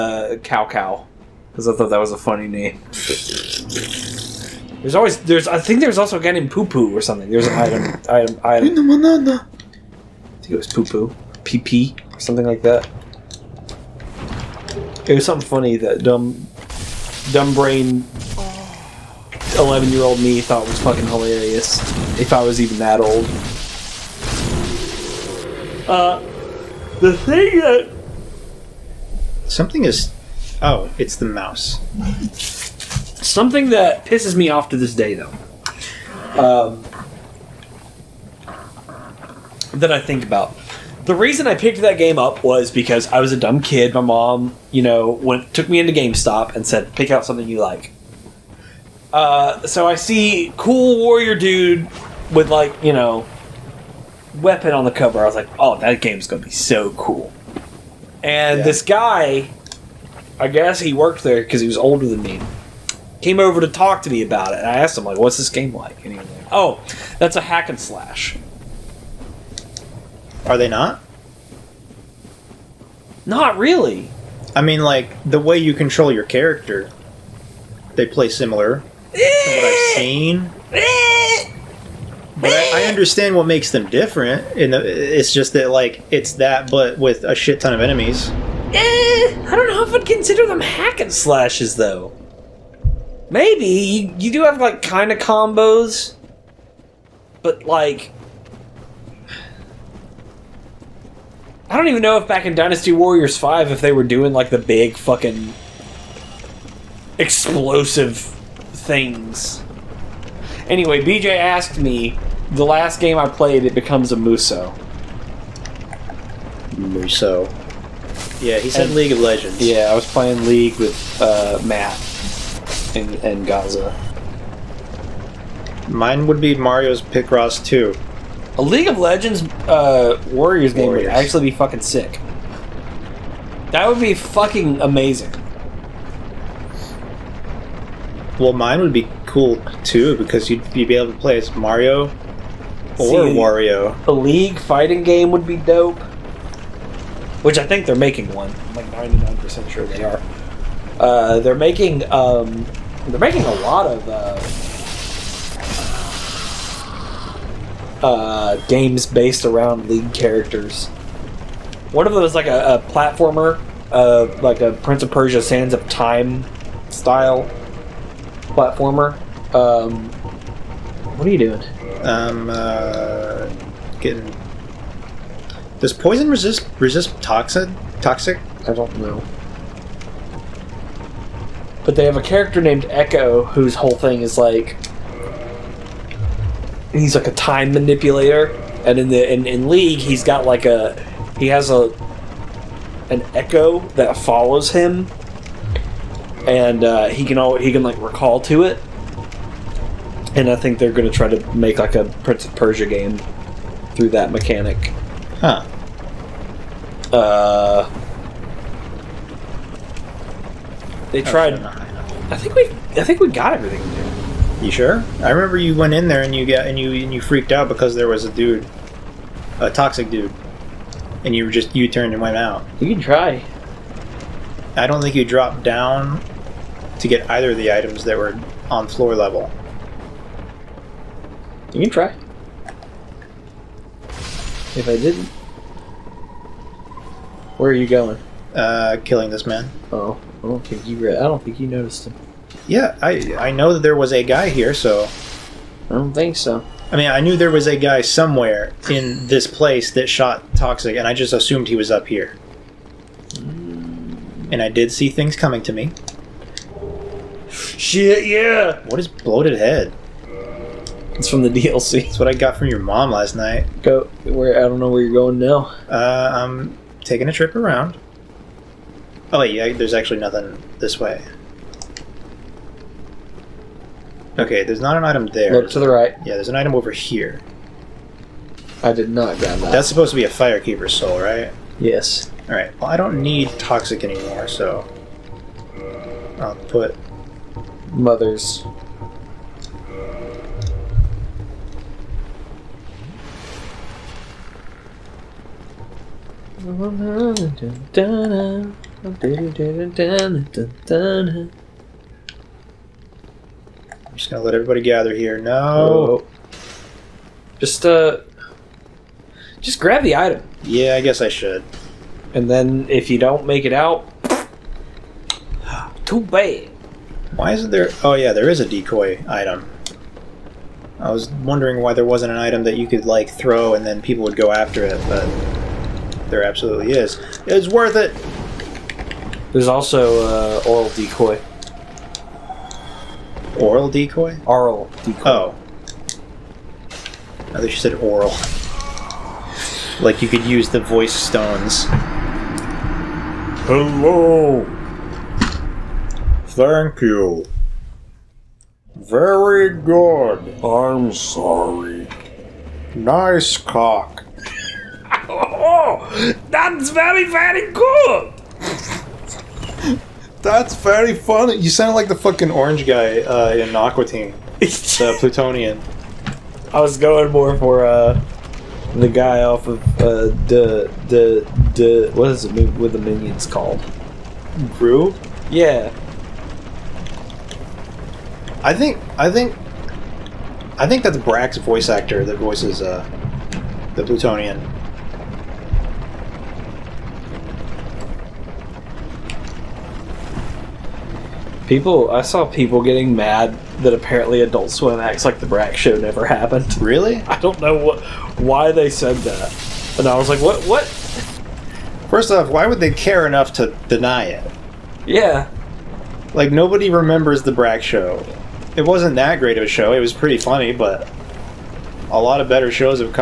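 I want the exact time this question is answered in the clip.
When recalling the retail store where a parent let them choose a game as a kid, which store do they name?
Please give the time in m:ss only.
0:45.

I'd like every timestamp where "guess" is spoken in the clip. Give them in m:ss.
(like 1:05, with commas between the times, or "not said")
1:00, 5:10.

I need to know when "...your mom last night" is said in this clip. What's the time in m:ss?
4:22.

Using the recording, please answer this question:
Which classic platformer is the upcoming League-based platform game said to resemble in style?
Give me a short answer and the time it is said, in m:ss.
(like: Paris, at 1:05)
Prince of Persia: Sands of Time, at 2:44.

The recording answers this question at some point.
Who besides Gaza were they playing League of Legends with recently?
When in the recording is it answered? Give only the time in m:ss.
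2:01.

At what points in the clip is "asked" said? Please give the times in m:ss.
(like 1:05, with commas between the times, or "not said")
1:04, 1:51.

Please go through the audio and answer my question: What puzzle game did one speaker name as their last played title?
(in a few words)
Mario's Picross 2.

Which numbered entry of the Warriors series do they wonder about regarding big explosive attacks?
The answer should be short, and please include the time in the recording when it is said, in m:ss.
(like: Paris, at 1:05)
Dynasty Warriors 5, at 1:42.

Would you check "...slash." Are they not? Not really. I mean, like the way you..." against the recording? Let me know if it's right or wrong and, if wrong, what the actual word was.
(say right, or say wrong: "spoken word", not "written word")
right.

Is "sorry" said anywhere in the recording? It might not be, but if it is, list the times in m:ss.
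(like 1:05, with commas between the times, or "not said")
5:51.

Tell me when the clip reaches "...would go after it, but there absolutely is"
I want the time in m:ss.
5:24.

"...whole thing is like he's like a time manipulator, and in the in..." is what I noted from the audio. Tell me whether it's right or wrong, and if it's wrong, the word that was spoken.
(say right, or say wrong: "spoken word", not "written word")
right.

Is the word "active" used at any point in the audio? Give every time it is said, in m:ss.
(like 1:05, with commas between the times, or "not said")
not said.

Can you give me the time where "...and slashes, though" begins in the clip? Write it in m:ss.
1:30.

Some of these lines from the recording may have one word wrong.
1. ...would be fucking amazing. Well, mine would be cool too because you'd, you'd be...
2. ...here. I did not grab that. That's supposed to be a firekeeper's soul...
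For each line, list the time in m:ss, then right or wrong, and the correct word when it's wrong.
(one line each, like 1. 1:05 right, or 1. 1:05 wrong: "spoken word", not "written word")
1. 2:13 right
2. 4:36 right.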